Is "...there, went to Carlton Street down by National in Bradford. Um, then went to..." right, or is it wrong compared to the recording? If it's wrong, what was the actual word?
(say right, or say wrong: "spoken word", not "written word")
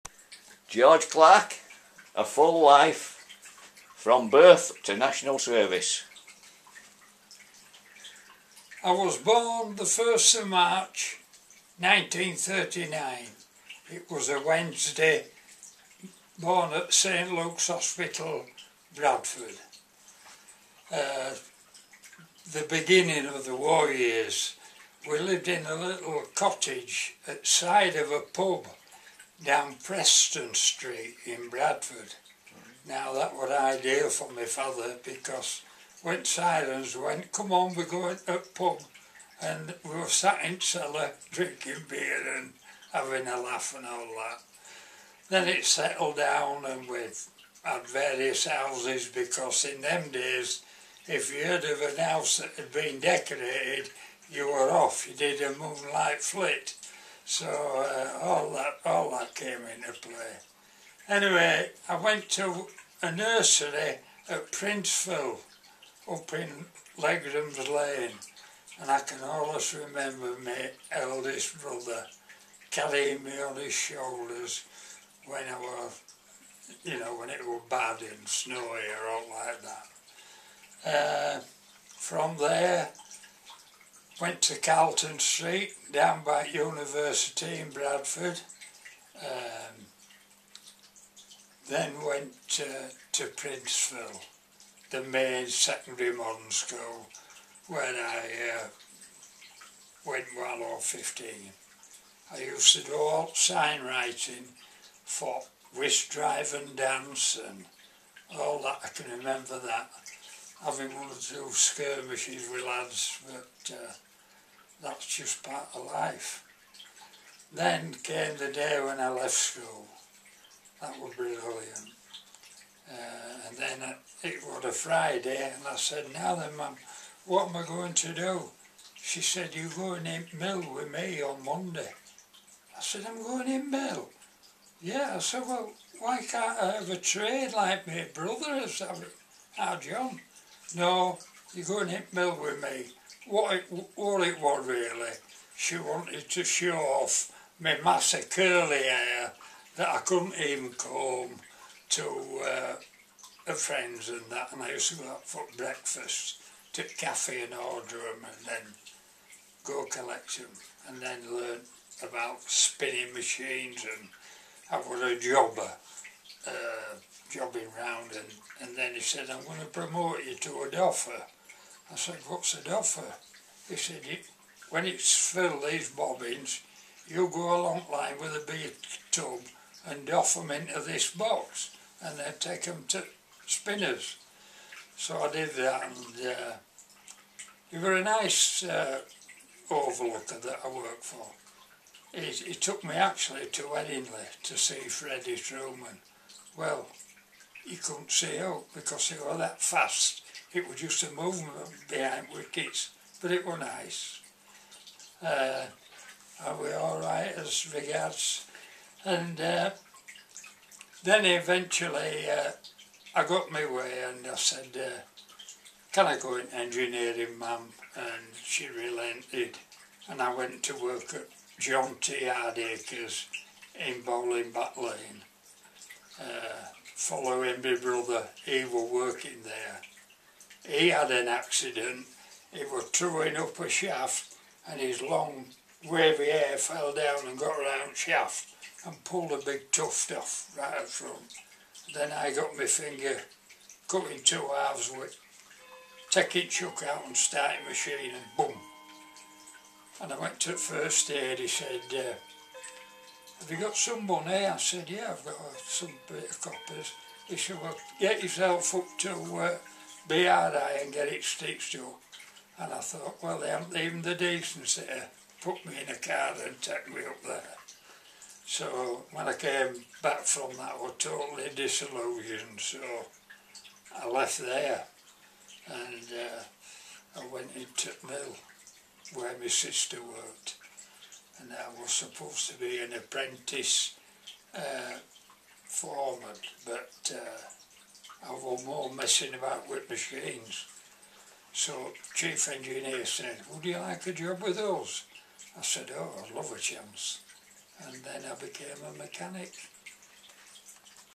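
wrong: "University", not "National".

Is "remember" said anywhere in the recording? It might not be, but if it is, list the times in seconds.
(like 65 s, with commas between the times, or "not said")
69 s, 109 s.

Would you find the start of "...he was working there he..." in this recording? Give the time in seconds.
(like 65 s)
228 s.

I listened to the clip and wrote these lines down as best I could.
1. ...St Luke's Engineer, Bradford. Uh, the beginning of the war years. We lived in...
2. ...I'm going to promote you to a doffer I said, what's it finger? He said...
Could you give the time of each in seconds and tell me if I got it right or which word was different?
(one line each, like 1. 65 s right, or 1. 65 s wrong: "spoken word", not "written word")
1. 16 s wrong: "Hospital", not "Engineer"
2. 169 s wrong: "offer", not "finger".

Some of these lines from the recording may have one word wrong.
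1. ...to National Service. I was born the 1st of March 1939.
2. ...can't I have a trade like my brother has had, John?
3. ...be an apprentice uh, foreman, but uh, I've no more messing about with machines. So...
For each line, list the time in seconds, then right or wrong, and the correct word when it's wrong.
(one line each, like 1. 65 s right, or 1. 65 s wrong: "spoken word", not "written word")
1. 4 s right
2. 136 s right
3. 282 s right.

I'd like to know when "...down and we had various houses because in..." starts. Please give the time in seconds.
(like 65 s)
46 s.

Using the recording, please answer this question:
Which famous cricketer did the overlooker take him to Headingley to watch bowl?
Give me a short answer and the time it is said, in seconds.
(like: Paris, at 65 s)
Freddie Trueman, at 194 s.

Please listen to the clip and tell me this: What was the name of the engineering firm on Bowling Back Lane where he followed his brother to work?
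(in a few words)
John T. Hardacres.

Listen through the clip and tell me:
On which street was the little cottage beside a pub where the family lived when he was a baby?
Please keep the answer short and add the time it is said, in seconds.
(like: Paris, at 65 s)
Preston Street, at 29 s.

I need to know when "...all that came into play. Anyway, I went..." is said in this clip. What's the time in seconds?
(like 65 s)
58 s.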